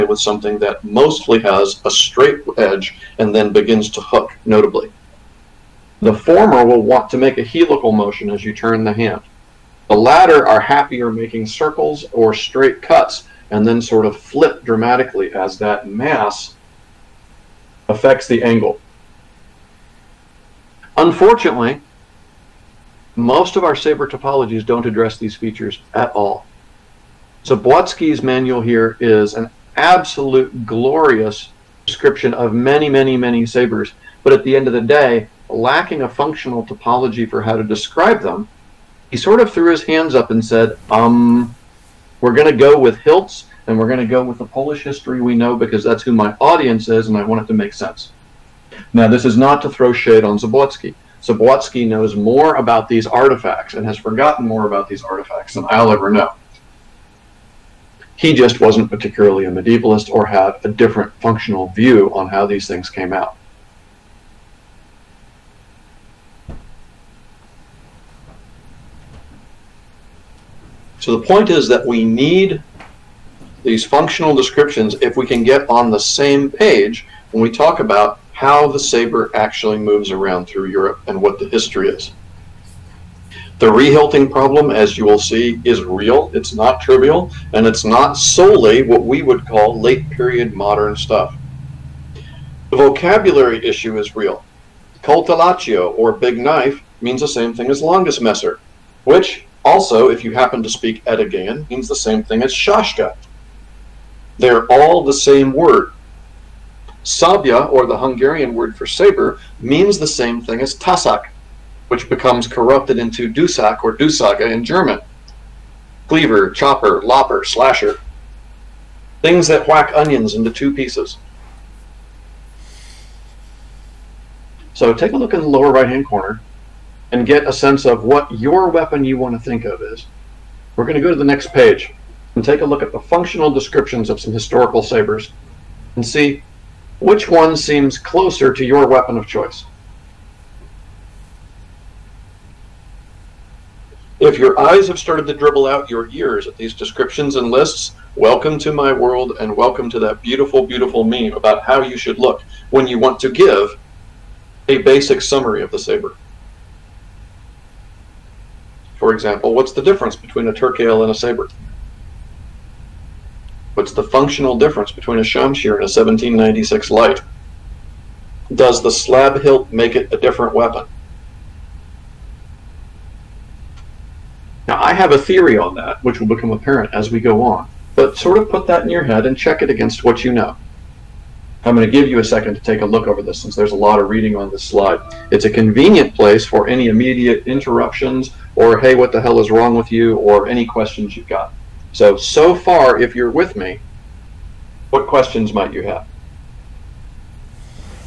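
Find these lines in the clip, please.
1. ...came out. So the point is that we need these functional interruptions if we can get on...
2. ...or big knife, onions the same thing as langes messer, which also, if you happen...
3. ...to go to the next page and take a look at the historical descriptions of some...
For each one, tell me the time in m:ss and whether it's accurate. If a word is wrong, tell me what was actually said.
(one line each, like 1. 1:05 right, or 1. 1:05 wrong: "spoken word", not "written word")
1. 1:02 wrong: "descriptions", not "interruptions"
2. 1:35 wrong: "means", not "onions"
3. 2:10 wrong: "functional", not "historical".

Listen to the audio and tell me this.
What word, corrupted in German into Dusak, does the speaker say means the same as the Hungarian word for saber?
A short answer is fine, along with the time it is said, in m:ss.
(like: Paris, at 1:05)
Tasak, at 1:50.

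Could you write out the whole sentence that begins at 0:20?
Unfortunately, most of our saber topologies don't address these features at all.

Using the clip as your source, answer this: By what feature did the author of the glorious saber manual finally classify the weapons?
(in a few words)
Hilts.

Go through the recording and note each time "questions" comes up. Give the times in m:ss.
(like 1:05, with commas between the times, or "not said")
3:10, 3:15.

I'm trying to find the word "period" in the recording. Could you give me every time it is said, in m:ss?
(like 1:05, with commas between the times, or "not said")
1:30.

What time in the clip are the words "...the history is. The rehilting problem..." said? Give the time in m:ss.
1:21.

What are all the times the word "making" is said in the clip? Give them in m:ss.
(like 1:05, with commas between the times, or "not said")
0:11.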